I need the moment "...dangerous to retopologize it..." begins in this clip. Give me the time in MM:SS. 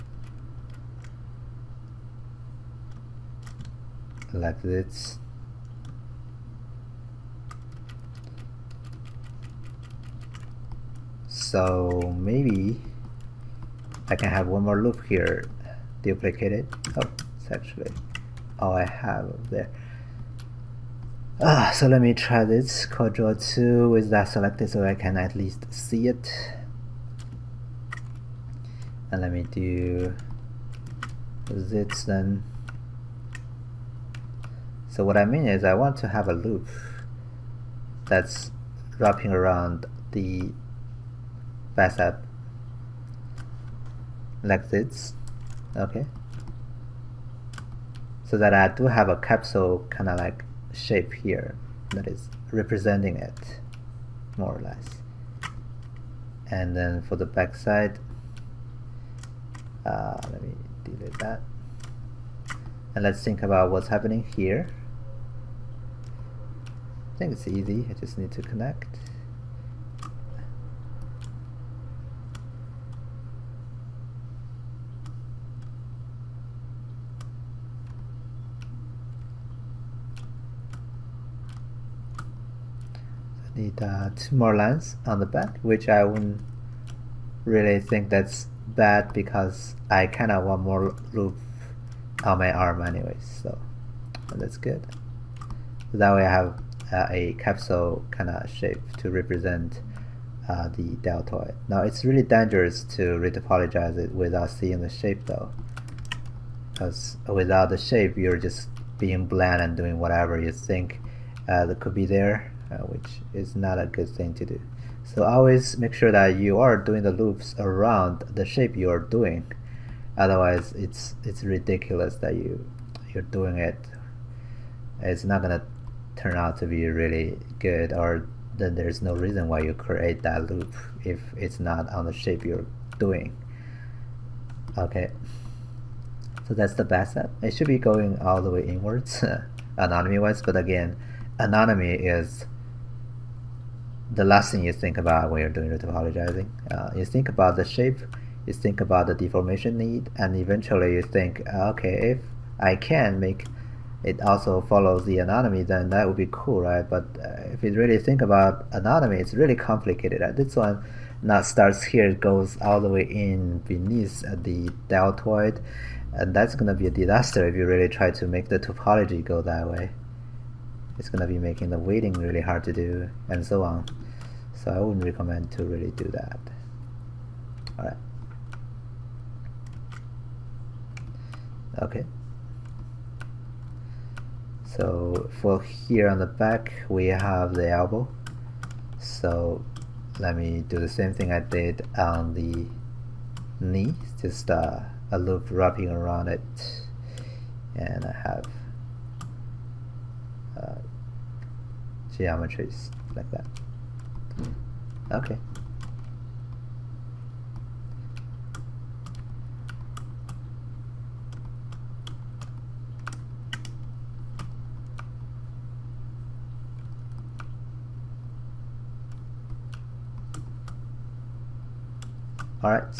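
01:42.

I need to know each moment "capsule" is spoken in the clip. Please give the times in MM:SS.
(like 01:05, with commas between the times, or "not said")
00:49, 01:37.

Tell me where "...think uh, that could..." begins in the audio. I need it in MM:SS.
01:50.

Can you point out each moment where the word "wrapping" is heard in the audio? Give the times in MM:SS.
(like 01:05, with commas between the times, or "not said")
00:38, 03:15.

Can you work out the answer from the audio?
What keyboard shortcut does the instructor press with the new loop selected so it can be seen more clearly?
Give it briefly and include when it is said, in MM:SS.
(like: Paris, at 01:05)
Ctrl 2, at 00:22.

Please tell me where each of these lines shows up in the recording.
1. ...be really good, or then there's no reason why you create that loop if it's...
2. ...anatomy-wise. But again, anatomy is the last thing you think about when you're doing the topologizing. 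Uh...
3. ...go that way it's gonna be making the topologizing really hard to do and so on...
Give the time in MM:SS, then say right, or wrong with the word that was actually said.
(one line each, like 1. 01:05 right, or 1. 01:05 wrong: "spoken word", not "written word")
1. 02:06 right
2. 02:19 right
3. 02:49 wrong: "weighting", not "topologizing".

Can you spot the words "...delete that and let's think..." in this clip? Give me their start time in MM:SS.
01:00.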